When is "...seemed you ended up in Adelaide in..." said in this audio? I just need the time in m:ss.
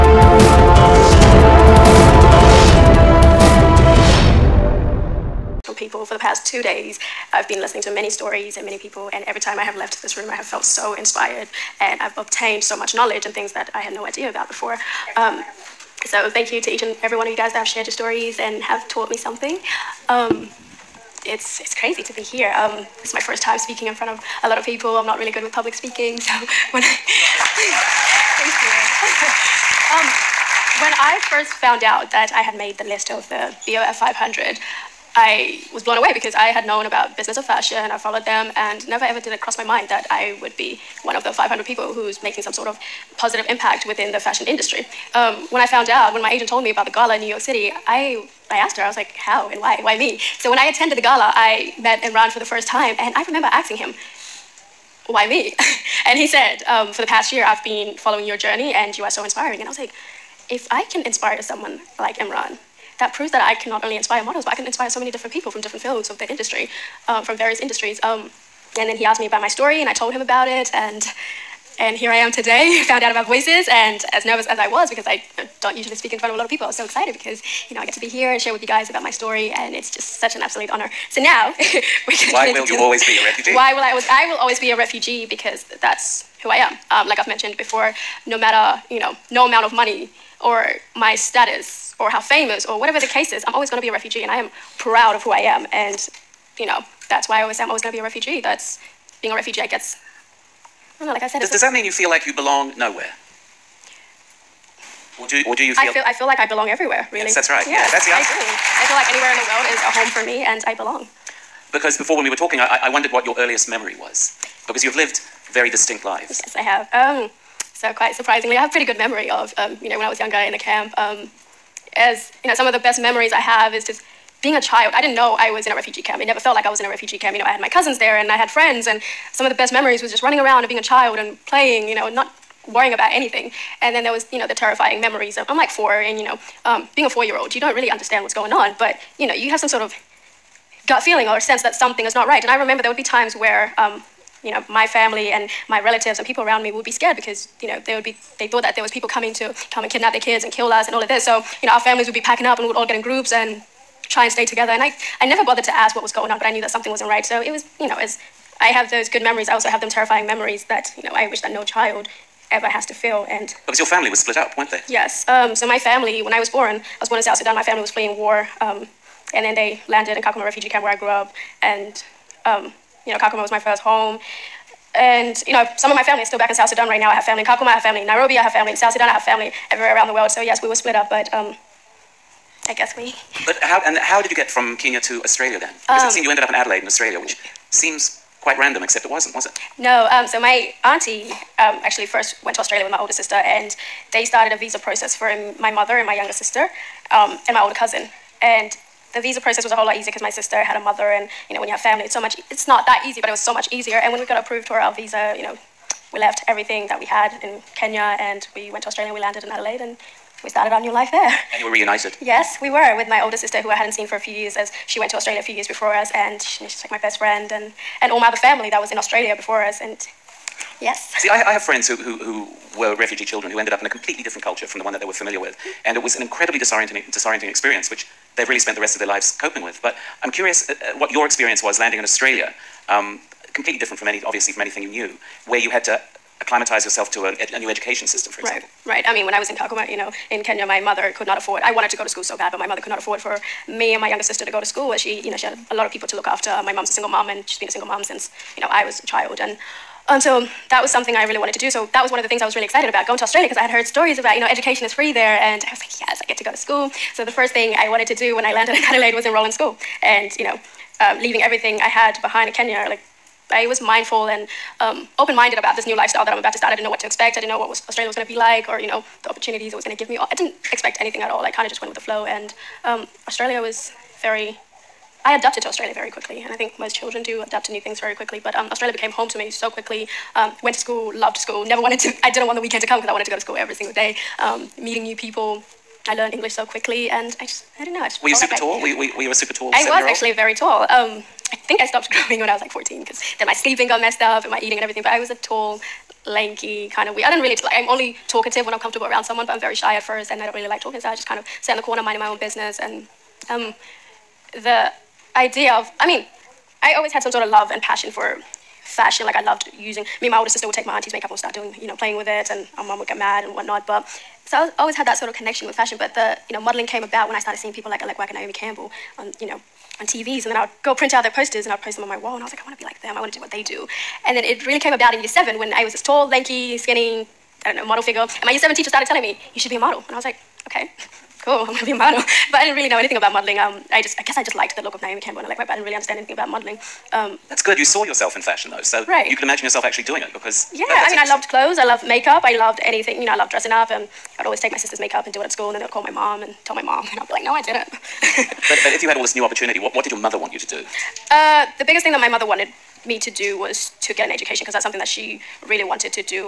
3:06.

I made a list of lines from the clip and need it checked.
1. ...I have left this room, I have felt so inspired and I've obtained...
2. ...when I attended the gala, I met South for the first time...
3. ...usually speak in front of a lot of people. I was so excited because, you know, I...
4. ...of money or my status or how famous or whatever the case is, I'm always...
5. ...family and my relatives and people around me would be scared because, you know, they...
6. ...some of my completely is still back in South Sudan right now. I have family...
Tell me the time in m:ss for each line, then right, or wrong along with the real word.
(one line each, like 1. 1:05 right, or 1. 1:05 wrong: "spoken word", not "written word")
1. 0:09 right
2. 0:50 wrong: "Imran", not "South"
3. 1:15 right
4. 1:29 right
5. 2:24 right
6. 2:55 wrong: "family", not "completely".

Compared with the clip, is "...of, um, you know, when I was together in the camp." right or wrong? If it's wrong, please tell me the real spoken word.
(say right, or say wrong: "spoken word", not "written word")
wrong: "younger", not "together".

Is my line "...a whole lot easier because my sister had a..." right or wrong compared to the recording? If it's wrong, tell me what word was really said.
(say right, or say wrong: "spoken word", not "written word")
right.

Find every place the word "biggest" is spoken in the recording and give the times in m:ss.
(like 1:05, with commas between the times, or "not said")
5:51.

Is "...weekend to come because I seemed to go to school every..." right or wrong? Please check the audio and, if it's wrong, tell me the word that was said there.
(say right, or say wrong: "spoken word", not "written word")
wrong: "wanted", not "seemed".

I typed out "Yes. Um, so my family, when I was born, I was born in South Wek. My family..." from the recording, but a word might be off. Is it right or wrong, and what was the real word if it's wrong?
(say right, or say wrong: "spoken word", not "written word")
wrong: "Sudan", not "Wek".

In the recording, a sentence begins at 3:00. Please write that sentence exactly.
So, yes, we were split up, but um, I guess we.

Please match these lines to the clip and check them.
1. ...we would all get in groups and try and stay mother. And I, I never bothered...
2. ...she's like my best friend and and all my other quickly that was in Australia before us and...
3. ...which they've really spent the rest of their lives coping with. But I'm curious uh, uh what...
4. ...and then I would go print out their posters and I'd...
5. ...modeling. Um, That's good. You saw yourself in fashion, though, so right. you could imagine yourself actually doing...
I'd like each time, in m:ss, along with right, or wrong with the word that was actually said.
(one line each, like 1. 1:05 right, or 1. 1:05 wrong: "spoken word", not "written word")
1. 2:32 wrong: "together", not "mother"
2. 3:36 wrong: "family", not "quickly"
3. 3:47 right
4. 5:20 right
5. 5:36 right.